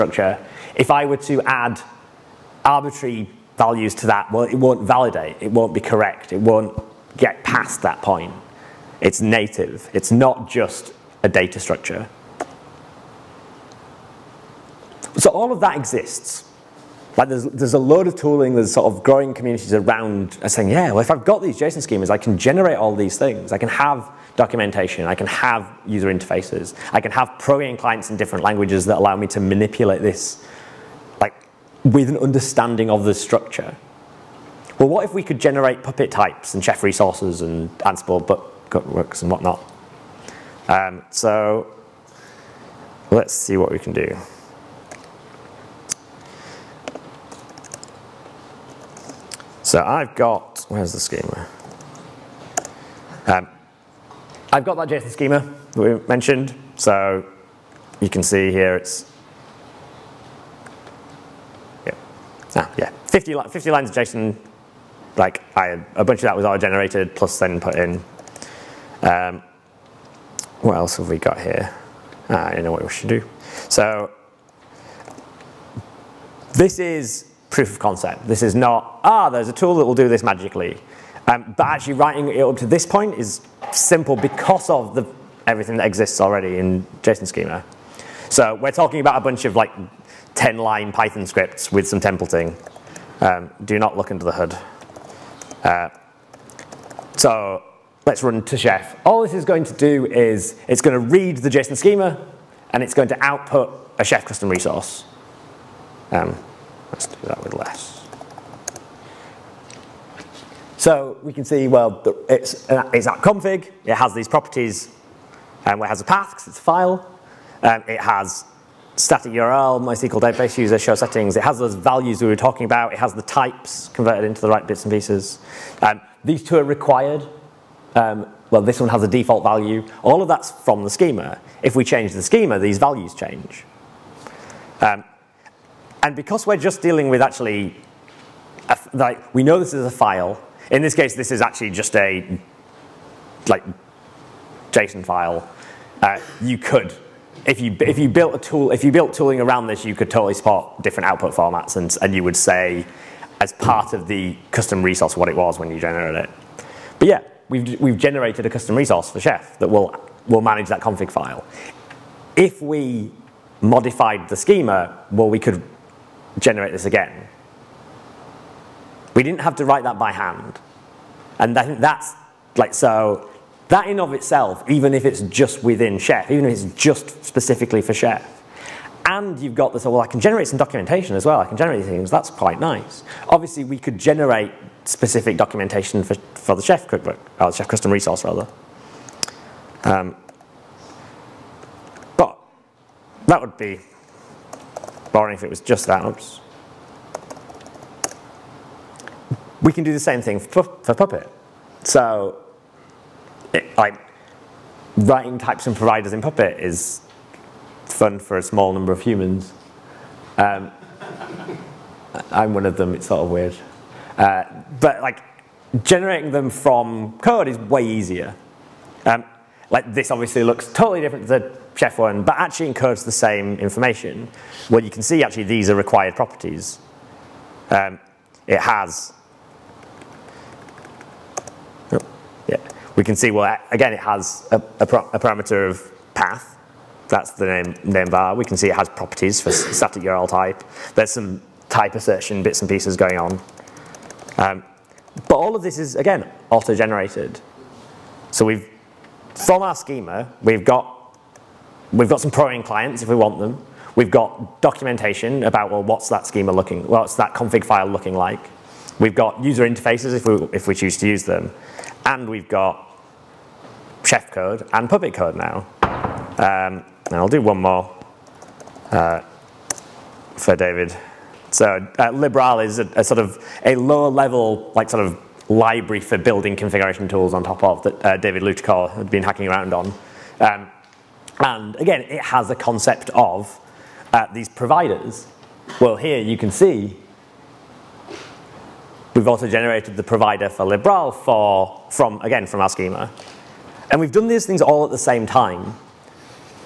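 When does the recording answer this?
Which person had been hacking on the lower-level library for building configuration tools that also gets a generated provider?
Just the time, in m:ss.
4:38.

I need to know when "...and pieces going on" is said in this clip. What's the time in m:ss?
4:02.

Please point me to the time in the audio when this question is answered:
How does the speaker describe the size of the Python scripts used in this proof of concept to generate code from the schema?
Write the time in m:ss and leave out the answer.
1:30.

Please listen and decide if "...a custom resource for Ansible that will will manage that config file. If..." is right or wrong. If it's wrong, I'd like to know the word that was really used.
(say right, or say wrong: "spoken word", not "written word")
wrong: "Chef", not "Ansible".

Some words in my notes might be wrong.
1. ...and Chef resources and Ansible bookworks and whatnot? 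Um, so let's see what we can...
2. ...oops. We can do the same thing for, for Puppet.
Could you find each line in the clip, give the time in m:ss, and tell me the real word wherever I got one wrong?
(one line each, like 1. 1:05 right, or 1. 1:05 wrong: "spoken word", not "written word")
1. 0:36 right
2. 3:16 right.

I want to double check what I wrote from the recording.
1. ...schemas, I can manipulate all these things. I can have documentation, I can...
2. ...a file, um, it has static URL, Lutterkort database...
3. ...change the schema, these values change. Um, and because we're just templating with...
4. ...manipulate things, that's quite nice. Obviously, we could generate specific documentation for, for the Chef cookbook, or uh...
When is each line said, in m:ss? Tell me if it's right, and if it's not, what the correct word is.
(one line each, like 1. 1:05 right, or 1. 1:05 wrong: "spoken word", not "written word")
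1. 0:21 wrong: "generate", not "manipulate"
2. 1:56 wrong: "MySQL", not "Lutterkort"
3. 2:11 wrong: "dealing", not "templating"
4. 3:01 wrong: "generate", not "manipulate".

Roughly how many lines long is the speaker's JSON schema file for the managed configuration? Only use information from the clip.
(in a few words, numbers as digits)
50.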